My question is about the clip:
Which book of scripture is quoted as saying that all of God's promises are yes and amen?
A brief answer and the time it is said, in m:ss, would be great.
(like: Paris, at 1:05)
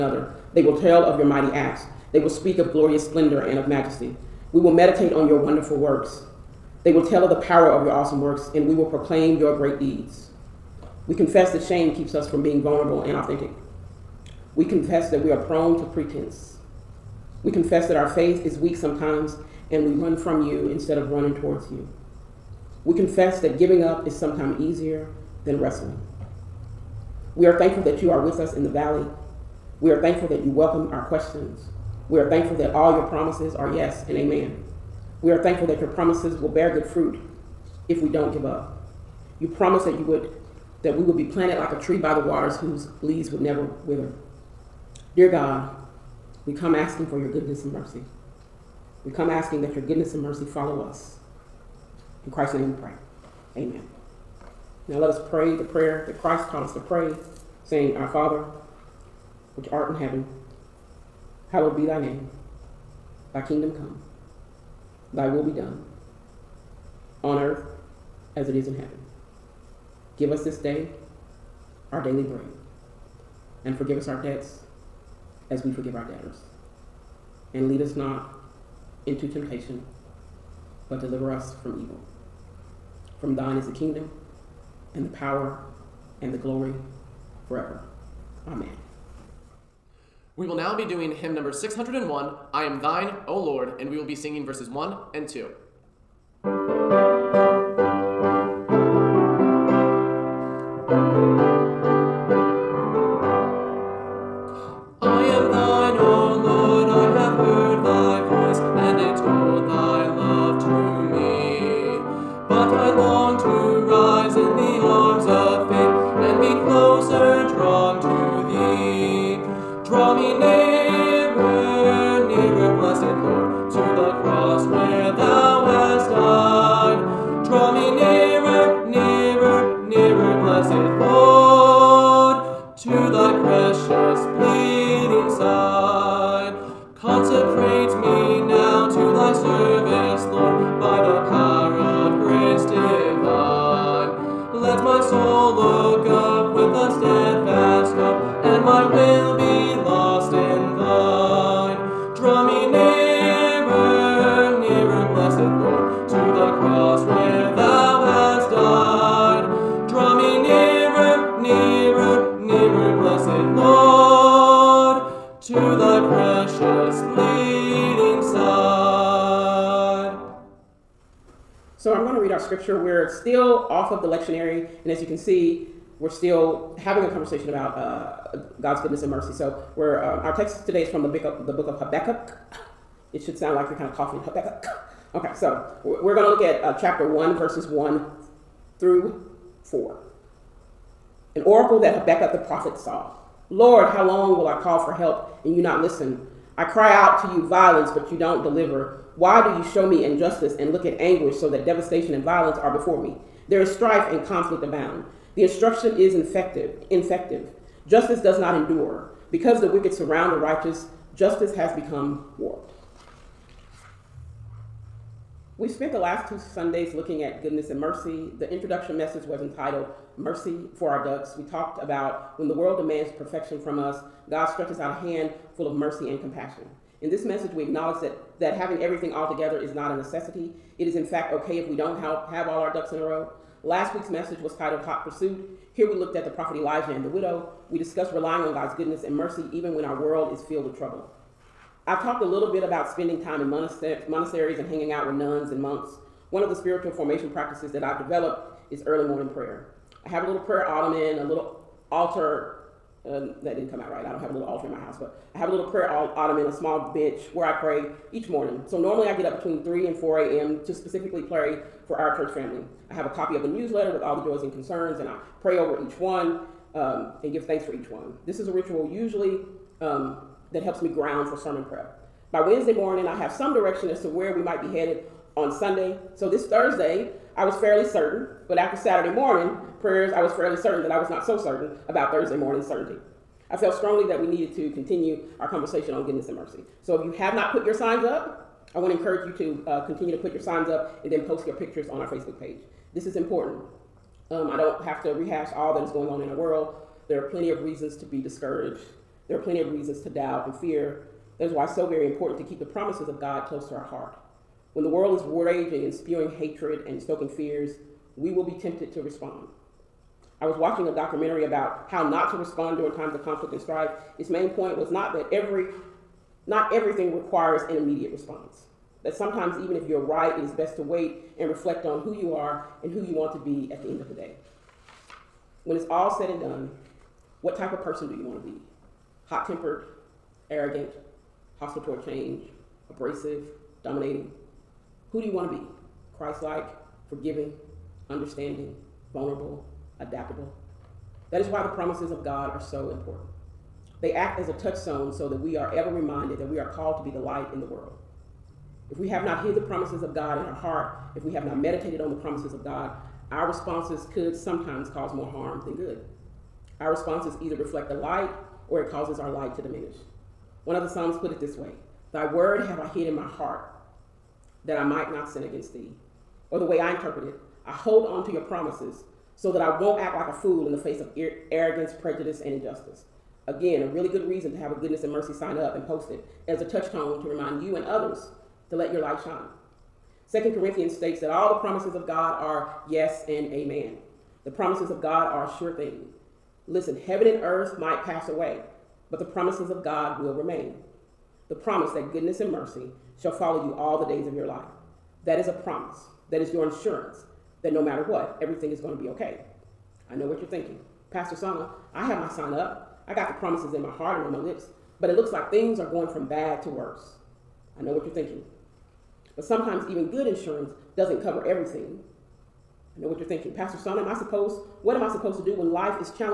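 Second Corinthians, at 6:20.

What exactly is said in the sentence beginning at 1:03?
Thy kingdom come, thy will be done, on earth as it is in heaven.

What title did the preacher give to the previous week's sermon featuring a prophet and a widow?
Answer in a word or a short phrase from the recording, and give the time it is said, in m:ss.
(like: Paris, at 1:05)
Hot Pursuit, at 3:54.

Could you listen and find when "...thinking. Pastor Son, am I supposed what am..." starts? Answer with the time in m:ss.
6:53.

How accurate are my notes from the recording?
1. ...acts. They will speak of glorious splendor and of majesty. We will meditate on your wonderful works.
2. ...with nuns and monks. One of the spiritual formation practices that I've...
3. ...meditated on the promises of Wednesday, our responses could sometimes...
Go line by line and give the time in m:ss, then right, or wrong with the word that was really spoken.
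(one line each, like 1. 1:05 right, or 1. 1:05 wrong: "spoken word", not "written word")
1. 0:01 right
2. 4:05 right
3. 5:51 wrong: "God", not "Wednesday".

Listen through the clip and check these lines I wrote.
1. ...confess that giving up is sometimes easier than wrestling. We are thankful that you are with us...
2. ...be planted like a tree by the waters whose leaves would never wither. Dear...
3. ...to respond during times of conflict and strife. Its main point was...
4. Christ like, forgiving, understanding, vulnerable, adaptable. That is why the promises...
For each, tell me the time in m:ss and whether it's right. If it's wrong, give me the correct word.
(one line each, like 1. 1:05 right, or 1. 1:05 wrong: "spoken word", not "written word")
1. 0:22 right
2. 0:41 right
3. 5:12 right
4. 5:36 right.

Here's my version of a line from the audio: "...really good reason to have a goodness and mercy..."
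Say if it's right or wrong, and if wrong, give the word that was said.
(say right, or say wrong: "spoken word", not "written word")
right.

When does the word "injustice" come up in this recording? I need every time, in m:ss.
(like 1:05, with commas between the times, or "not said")
3:20, 6:12.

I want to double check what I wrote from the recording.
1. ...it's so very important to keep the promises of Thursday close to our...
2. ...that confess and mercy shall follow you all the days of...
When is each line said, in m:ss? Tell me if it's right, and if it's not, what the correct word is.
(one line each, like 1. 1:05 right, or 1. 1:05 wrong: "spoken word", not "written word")
1. 5:01 wrong: "God", not "Thursday"
2. 6:31 wrong: "goodness", not "confess".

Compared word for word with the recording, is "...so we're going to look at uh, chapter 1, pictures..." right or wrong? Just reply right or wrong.
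wrong.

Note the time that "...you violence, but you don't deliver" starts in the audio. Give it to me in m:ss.
3:17.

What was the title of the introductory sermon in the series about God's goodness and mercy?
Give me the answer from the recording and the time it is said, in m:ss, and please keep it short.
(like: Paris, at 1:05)
Mercy for Our Ducks, at 3:40.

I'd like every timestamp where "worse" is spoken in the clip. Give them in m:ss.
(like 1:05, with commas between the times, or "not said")
6:46.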